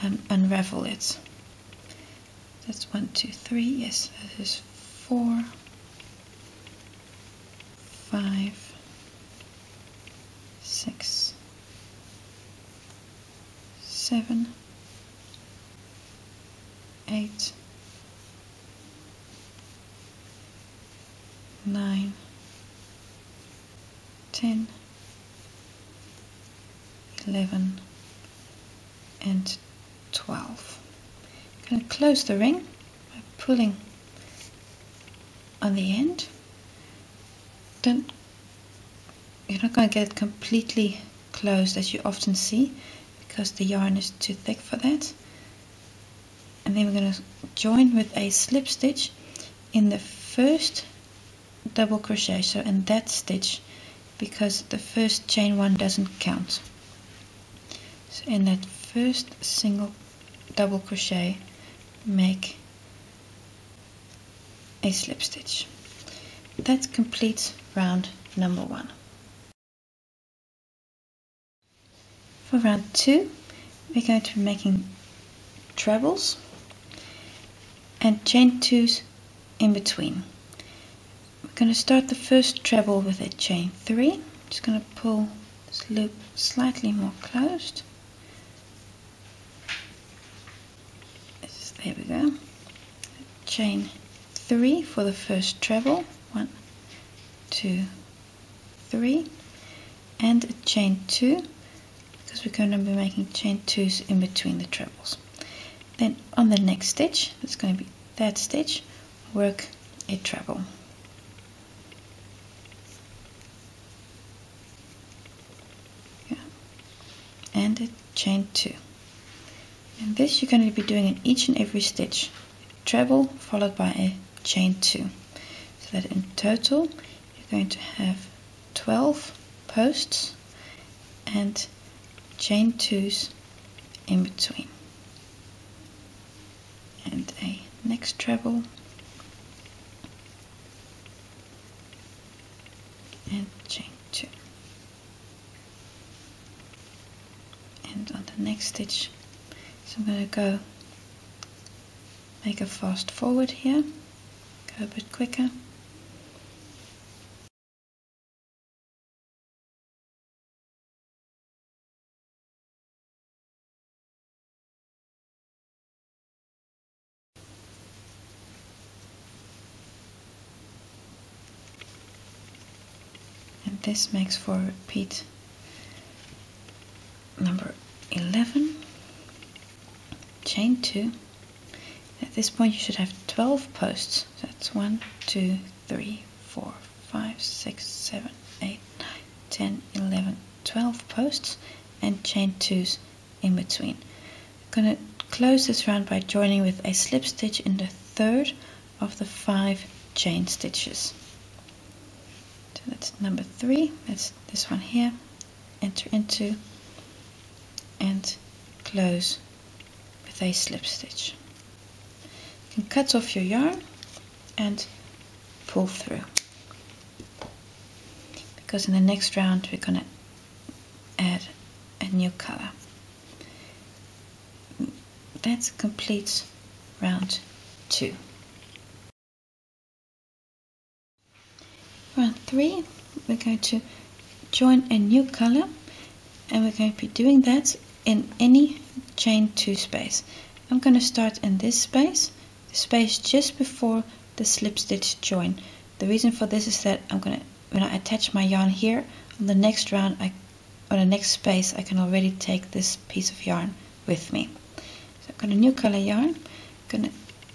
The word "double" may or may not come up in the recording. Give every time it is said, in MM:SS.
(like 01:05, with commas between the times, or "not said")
00:51, 01:00.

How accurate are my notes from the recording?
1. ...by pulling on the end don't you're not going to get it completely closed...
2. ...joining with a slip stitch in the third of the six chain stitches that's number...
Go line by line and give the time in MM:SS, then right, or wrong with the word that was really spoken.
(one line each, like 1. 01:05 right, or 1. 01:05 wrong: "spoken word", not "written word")
1. 00:32 right
2. 03:16 wrong: "five", not "six".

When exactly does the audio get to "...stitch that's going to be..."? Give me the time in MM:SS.
01:46.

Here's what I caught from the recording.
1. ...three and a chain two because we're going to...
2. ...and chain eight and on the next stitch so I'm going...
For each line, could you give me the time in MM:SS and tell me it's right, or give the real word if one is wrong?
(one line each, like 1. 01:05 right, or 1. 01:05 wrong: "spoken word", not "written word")
1. 01:38 right
2. 02:23 wrong: "two", not "eight".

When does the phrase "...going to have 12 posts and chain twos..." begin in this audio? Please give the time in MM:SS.
02:07.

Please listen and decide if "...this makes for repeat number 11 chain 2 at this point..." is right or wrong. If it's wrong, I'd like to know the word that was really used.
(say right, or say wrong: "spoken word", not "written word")
right.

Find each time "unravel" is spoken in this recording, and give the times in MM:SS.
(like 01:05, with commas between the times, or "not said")
00:00.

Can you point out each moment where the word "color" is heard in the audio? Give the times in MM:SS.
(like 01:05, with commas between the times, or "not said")
03:42, 03:55, 04:15.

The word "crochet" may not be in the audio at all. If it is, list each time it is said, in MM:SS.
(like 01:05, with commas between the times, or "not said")
00:51, 01:00.